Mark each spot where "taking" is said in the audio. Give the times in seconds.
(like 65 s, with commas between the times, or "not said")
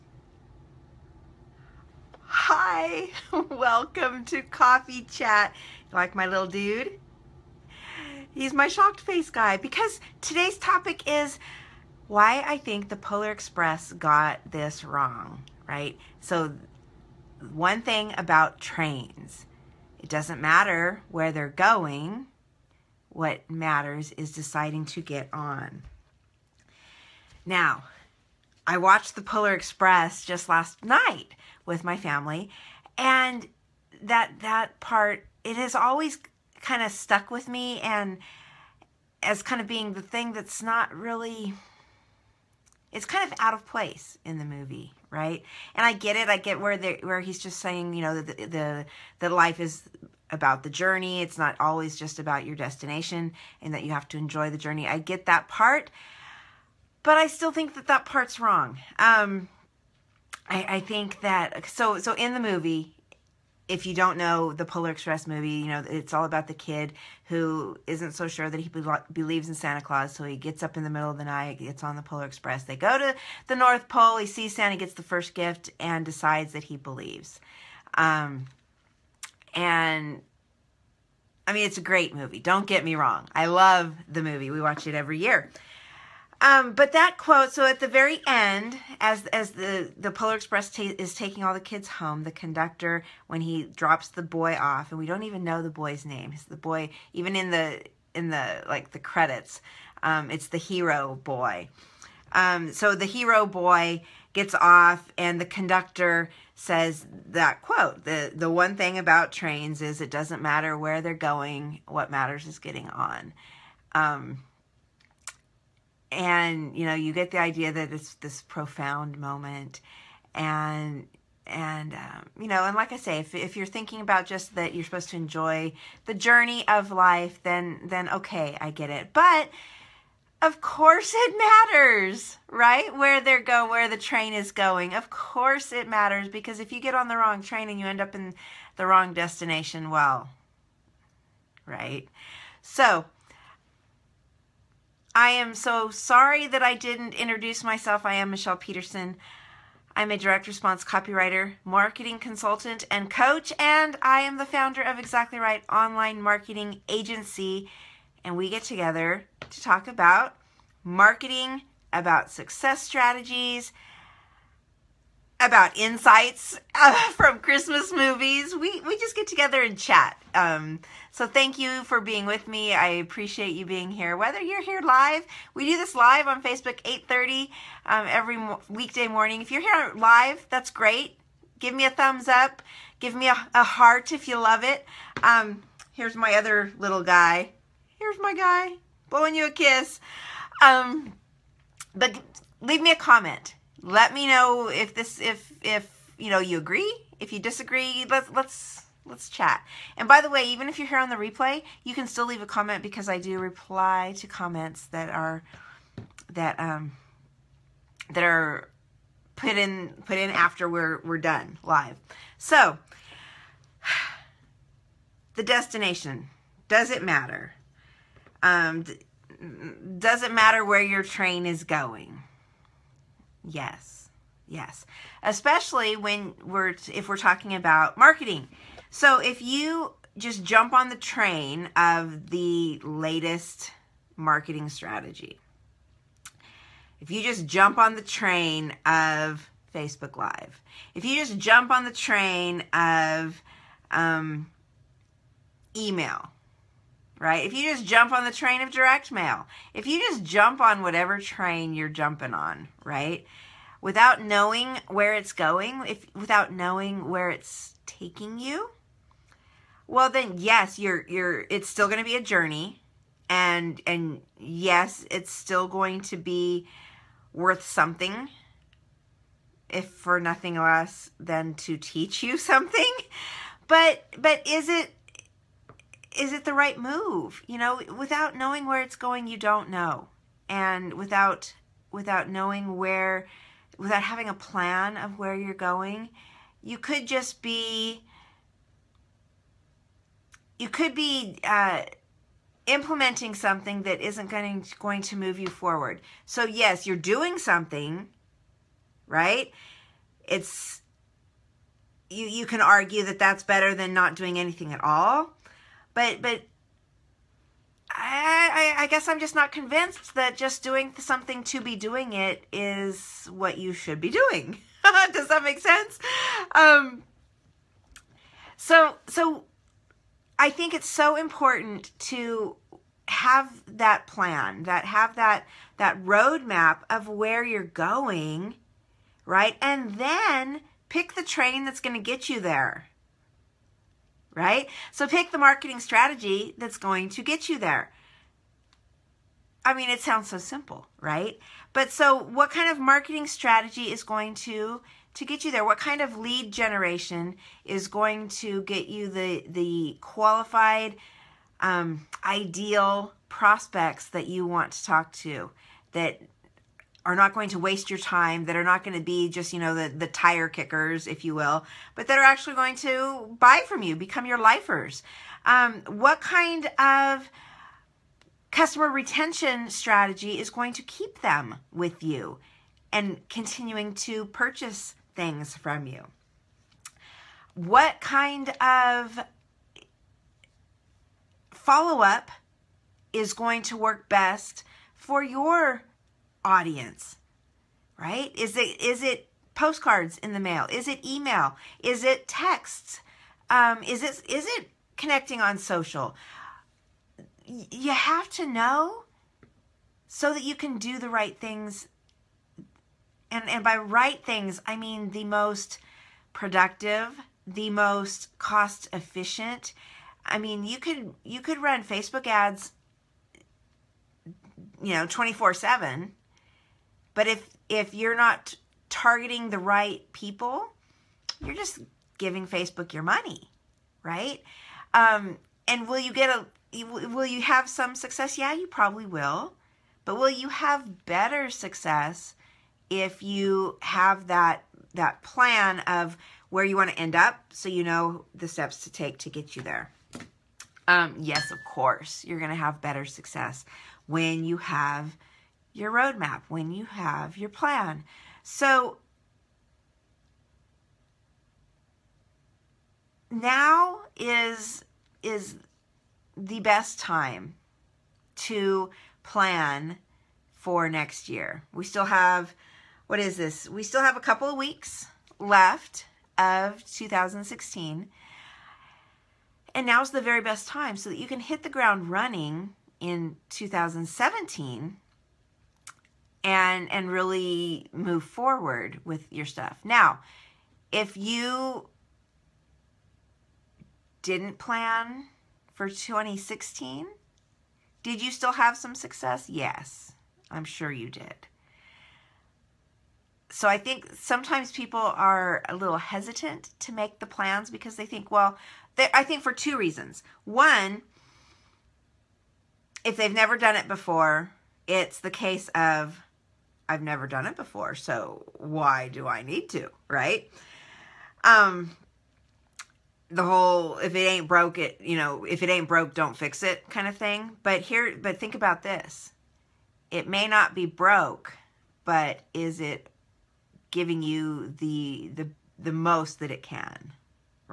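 91 s, 257 s.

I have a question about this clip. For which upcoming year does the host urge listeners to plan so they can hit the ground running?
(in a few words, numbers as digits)
2017.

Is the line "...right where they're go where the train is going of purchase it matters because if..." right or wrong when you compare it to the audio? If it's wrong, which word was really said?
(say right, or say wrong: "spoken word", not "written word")
wrong: "course", not "purchase".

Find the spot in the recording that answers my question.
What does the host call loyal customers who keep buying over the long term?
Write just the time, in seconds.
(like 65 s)
364 s.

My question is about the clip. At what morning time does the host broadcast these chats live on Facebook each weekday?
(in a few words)
8:30.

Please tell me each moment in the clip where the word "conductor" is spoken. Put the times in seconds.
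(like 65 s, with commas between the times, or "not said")
92 s, 105 s.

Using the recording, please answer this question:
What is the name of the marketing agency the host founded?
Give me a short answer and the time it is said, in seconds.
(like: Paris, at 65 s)
Exactly Write, at 154 s.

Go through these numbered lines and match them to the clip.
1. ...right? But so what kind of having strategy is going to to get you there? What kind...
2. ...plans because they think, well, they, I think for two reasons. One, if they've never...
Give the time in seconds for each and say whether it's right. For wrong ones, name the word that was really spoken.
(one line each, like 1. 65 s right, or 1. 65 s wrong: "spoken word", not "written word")
1. 340 s wrong: "marketing", not "having"
2. 497 s right.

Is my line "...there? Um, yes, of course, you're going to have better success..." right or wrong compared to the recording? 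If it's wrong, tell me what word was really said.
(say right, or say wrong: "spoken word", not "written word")
right.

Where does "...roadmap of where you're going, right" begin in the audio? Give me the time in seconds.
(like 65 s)
326 s.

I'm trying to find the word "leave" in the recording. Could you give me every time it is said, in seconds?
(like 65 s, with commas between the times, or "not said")
192 s, 202 s.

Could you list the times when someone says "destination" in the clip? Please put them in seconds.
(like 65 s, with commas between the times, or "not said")
52 s, 139 s, 215 s.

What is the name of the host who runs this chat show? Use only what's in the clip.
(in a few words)
Michele Peterson.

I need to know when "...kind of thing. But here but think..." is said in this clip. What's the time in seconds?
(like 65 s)
516 s.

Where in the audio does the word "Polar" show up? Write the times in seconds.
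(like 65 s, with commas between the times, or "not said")
12 s, 29 s, 64 s, 72 s, 90 s.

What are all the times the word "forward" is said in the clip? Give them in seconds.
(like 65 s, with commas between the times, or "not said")
295 s, 478 s.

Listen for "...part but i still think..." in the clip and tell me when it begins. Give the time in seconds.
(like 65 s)
55 s.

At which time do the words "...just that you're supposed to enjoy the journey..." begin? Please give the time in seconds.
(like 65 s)
124 s.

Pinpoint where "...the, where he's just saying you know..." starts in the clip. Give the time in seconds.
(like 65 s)
46 s.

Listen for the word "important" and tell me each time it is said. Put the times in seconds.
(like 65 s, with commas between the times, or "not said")
321 s.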